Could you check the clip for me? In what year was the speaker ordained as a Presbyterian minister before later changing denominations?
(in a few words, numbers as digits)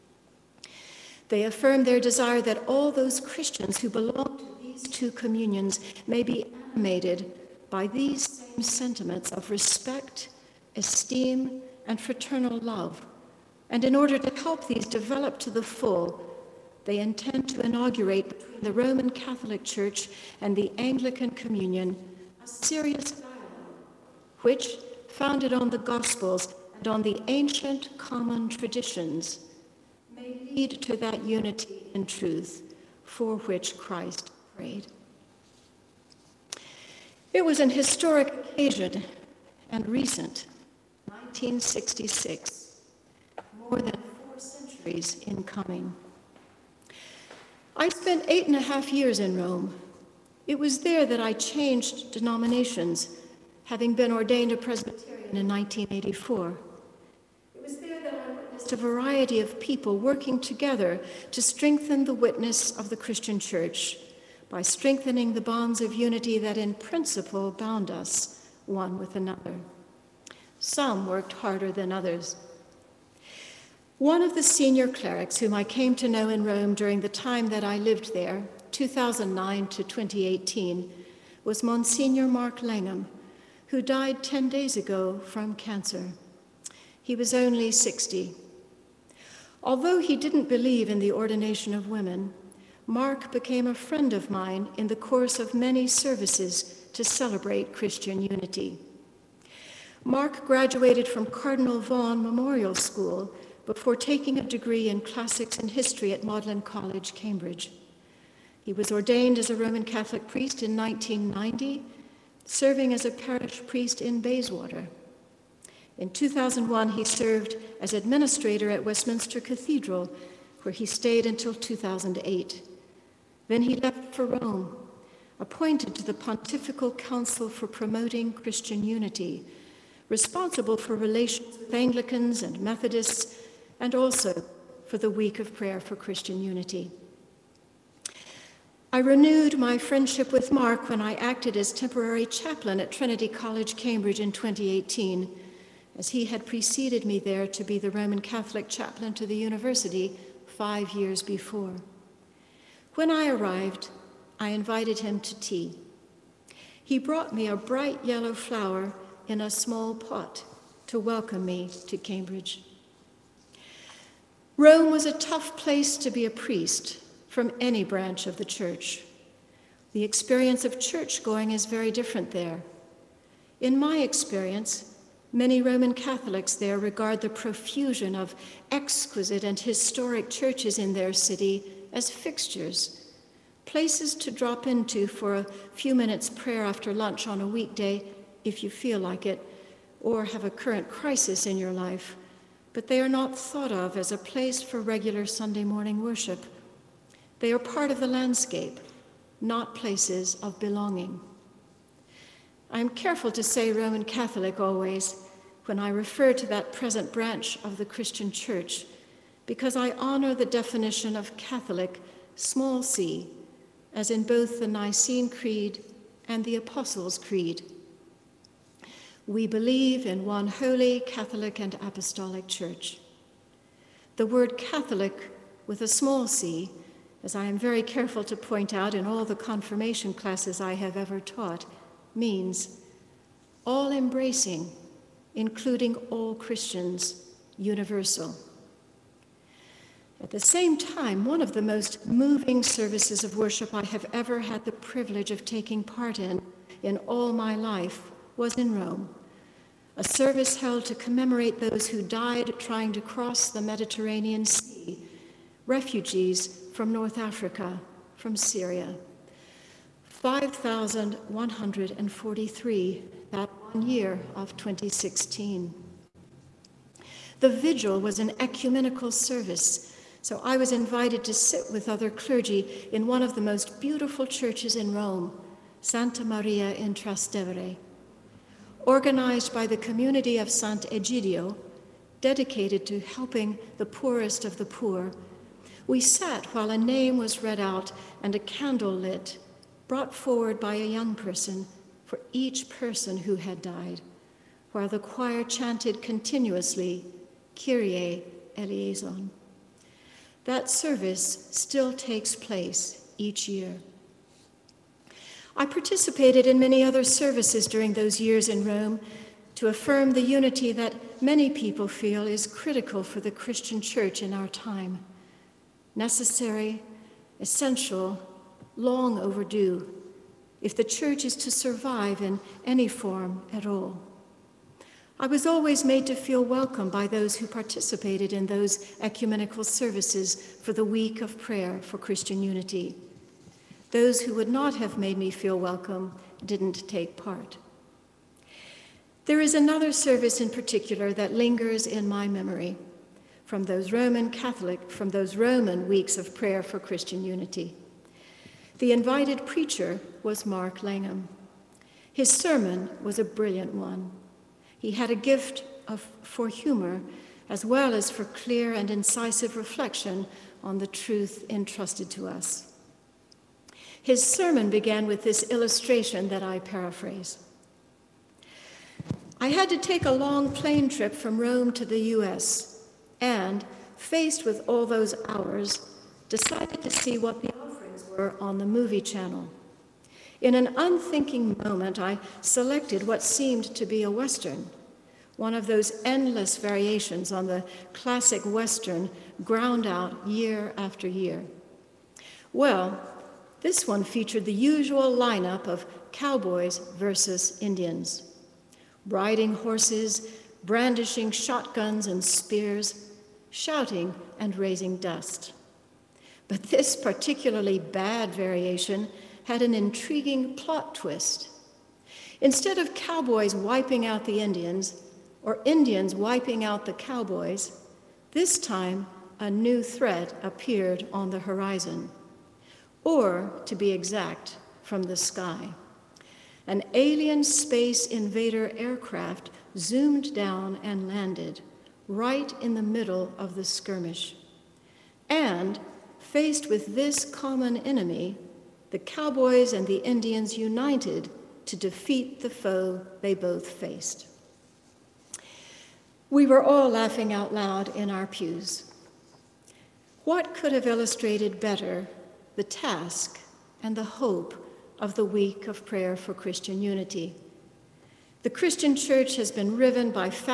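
1984.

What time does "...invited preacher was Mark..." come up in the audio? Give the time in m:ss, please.
5:48.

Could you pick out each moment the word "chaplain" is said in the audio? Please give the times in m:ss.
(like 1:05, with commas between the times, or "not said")
2:22, 2:28.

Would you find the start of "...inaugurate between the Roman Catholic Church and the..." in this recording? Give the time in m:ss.
0:17.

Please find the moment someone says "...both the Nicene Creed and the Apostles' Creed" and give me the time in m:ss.
3:34.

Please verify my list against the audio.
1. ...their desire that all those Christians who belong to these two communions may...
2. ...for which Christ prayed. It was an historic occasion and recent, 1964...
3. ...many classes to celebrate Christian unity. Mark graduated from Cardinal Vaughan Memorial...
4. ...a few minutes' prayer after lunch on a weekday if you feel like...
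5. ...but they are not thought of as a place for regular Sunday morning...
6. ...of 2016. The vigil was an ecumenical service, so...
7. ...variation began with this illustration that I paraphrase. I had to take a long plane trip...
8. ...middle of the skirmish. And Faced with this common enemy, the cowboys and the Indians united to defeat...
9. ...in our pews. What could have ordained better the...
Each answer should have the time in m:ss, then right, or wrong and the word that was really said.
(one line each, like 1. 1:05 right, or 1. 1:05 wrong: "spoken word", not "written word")
1. 0:01 right
2. 0:33 wrong: "1966", not "1964"
3. 1:35 wrong: "services", not "classes"
4. 3:05 right
5. 3:12 right
6. 4:24 right
7. 6:04 wrong: "sermon", not "variation"
8. 7:12 right
9. 7:27 wrong: "illustrated", not "ordained".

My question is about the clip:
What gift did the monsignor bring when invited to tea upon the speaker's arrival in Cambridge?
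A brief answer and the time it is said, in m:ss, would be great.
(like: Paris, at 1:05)
A bright yellow flower, at 2:37.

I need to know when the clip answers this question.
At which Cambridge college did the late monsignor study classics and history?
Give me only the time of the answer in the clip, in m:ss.
1:46.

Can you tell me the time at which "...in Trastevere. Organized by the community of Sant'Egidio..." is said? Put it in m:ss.
4:36.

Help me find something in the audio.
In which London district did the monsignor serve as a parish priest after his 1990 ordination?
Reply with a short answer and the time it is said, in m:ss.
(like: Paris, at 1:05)
Bayswater, at 1:54.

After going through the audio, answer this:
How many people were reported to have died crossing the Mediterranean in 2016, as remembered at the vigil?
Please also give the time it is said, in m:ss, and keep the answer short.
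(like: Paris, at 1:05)
5,143, at 4:20.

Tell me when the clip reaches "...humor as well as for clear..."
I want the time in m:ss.
5:56.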